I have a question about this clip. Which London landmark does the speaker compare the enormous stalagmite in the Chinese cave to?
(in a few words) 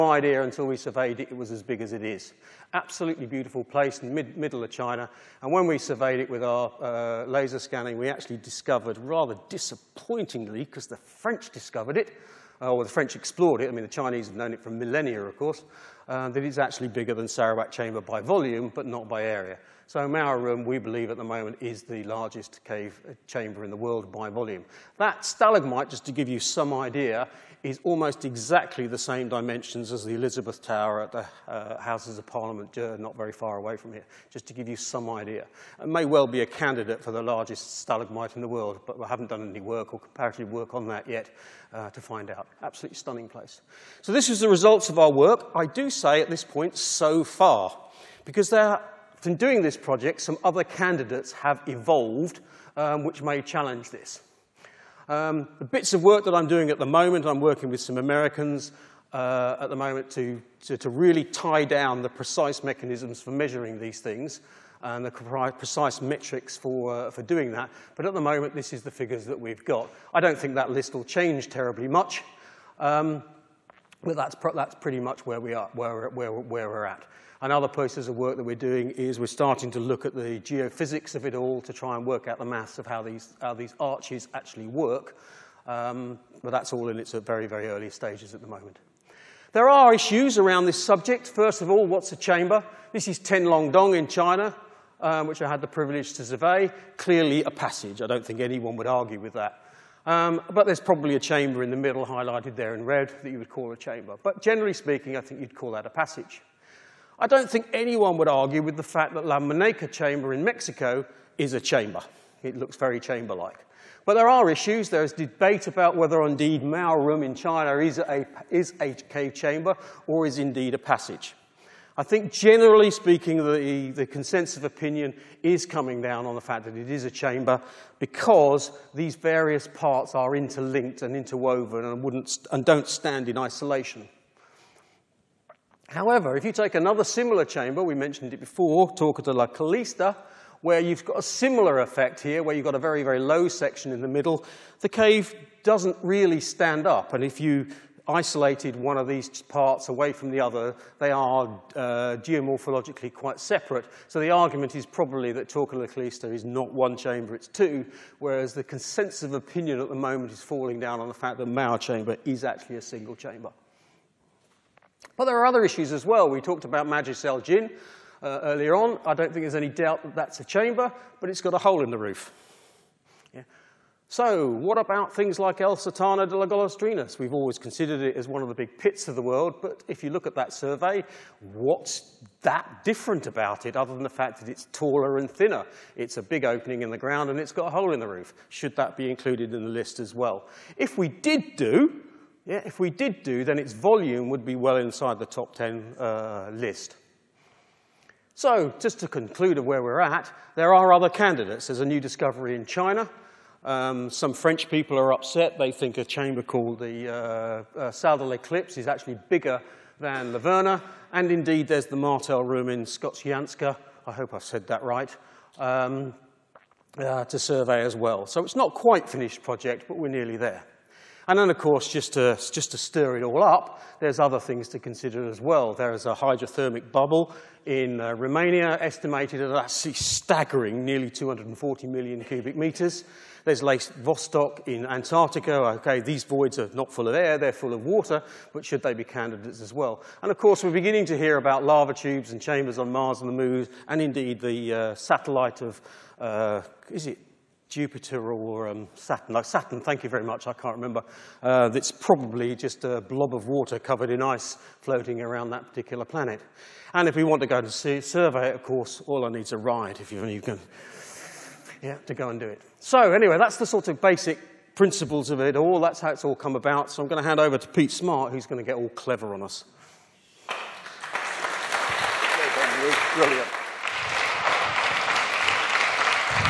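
Elizabeth Tower.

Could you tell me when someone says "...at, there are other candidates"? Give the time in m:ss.
3:19.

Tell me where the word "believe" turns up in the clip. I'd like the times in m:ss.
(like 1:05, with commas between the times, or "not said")
0:20.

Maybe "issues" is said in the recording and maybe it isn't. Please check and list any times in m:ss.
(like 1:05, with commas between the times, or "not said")
1:29, 1:54, 2:45.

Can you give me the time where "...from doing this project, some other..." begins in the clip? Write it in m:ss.
0:49.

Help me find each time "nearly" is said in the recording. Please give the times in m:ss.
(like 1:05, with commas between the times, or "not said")
3:40, 3:50.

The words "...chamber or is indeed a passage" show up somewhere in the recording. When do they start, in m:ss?
1:59.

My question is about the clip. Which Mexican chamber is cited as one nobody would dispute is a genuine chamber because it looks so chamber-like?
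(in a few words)
La Maneca.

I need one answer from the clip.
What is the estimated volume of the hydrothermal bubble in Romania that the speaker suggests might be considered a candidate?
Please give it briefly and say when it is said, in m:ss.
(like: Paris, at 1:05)
240 million cubic meters, at 3:51.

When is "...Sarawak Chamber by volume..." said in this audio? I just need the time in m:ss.
0:17.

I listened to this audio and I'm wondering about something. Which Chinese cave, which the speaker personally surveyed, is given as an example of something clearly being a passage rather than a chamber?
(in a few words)
Tenglongdong.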